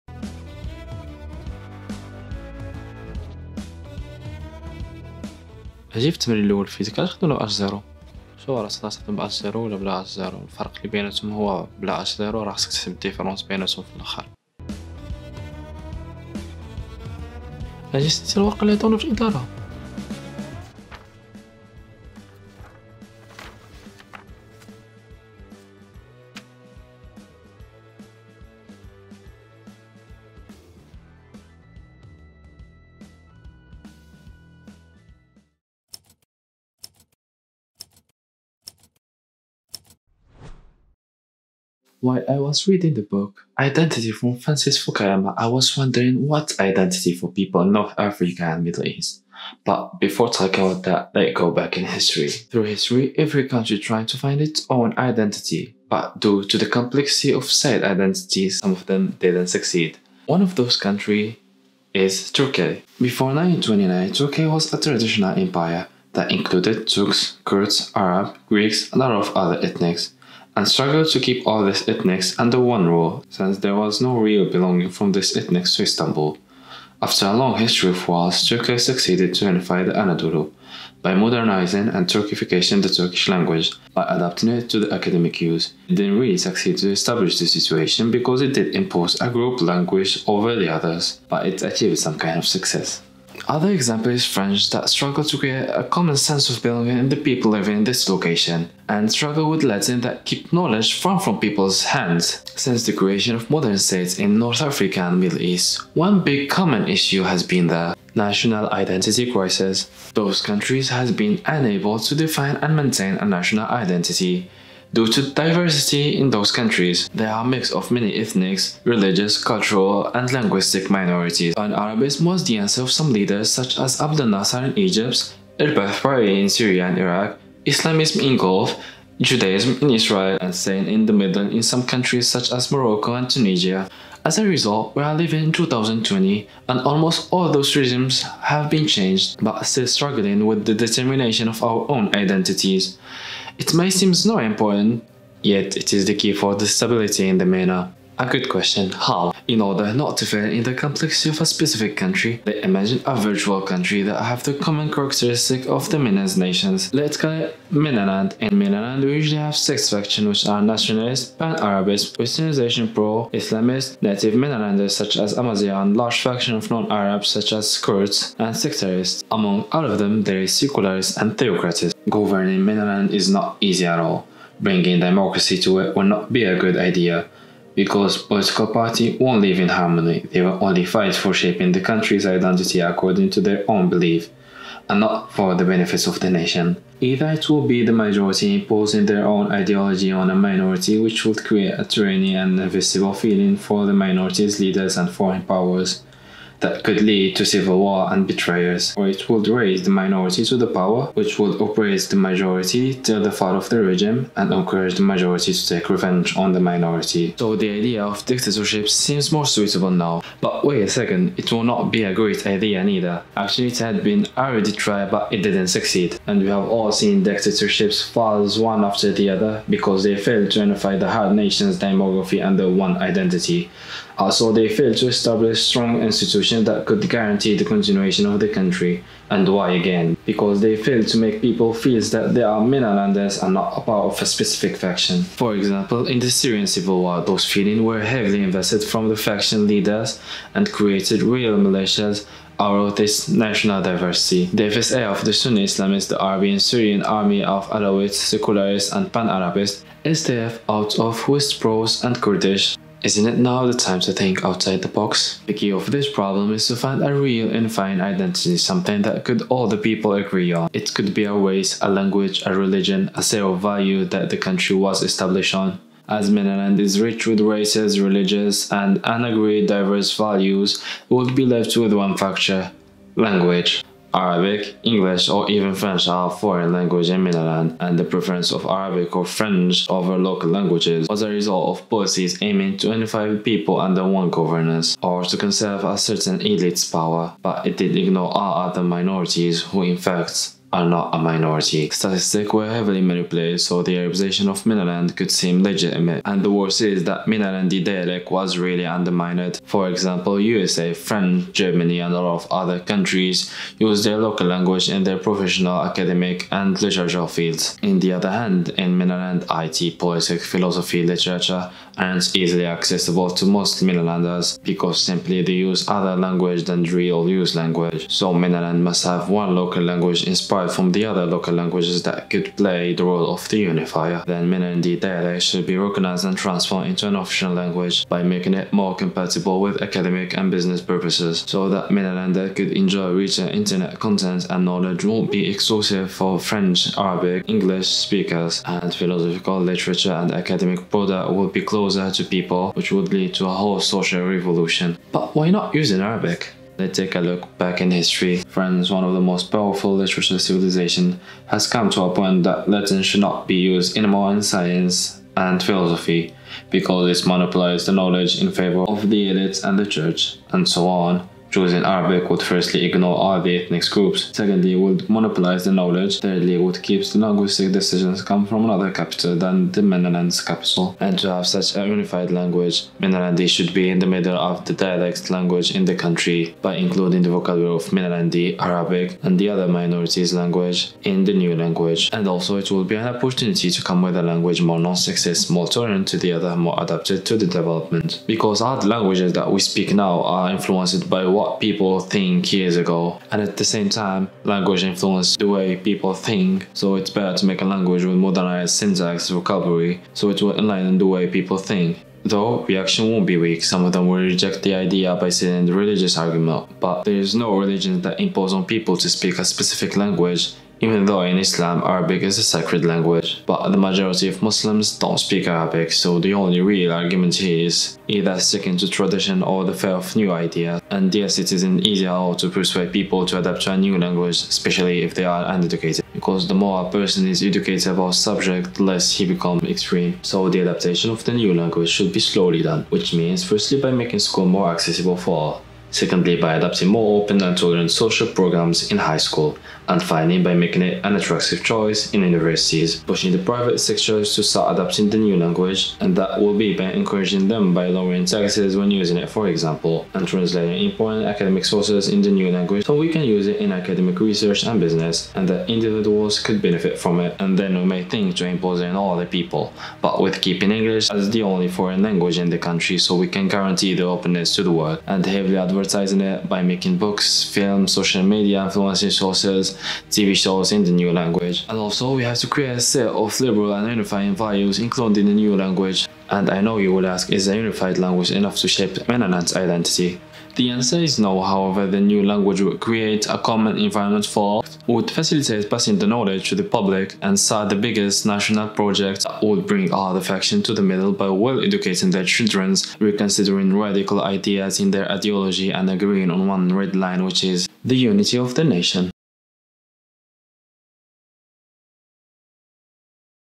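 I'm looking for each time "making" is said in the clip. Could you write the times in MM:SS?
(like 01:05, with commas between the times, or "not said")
05:28, 07:13, 07:20, 07:46.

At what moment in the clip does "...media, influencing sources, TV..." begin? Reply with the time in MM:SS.
07:48.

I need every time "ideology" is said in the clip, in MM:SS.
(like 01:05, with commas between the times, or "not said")
03:09, 08:15.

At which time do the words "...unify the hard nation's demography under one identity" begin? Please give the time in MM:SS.
03:40.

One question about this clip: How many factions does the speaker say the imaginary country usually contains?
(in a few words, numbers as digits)
six.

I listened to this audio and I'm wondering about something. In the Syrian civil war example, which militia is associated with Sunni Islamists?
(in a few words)
FSA.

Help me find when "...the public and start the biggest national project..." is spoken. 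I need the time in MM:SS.
08:06.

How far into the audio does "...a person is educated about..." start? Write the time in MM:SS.
07:06.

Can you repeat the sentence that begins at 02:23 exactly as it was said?
It may seem not important, yet it is the key for the stability in the MENA.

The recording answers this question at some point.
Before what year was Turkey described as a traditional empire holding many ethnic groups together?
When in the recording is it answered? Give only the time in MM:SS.
01:03.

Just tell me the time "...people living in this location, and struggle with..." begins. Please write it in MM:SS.
01:37.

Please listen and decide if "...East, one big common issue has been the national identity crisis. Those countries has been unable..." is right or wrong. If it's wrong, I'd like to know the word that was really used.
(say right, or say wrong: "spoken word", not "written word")
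right.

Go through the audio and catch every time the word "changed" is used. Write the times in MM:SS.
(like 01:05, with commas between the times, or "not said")
02:18.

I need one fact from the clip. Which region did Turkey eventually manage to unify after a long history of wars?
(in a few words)
Anadolu.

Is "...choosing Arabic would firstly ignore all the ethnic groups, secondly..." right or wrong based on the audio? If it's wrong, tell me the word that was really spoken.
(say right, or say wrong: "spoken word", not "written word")
right.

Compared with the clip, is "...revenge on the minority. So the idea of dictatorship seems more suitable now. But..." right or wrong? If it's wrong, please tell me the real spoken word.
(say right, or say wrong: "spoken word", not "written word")
right.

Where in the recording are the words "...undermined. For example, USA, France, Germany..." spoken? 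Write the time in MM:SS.
04:58.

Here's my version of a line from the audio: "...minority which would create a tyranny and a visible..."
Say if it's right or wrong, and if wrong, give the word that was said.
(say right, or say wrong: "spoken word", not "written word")
right.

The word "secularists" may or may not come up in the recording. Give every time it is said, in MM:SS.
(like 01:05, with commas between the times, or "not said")
02:50, 04:08.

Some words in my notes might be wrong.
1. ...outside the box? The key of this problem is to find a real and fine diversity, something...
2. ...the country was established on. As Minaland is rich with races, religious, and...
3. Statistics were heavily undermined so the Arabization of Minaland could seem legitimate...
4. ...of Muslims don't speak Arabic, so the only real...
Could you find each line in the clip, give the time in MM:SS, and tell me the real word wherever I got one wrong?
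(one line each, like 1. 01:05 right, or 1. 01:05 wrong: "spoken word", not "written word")
1. 04:14 wrong: "identity", not "diversity"
2. 04:24 right
3. 04:51 wrong: "manipulated", not "undermined"
4. 06:54 right.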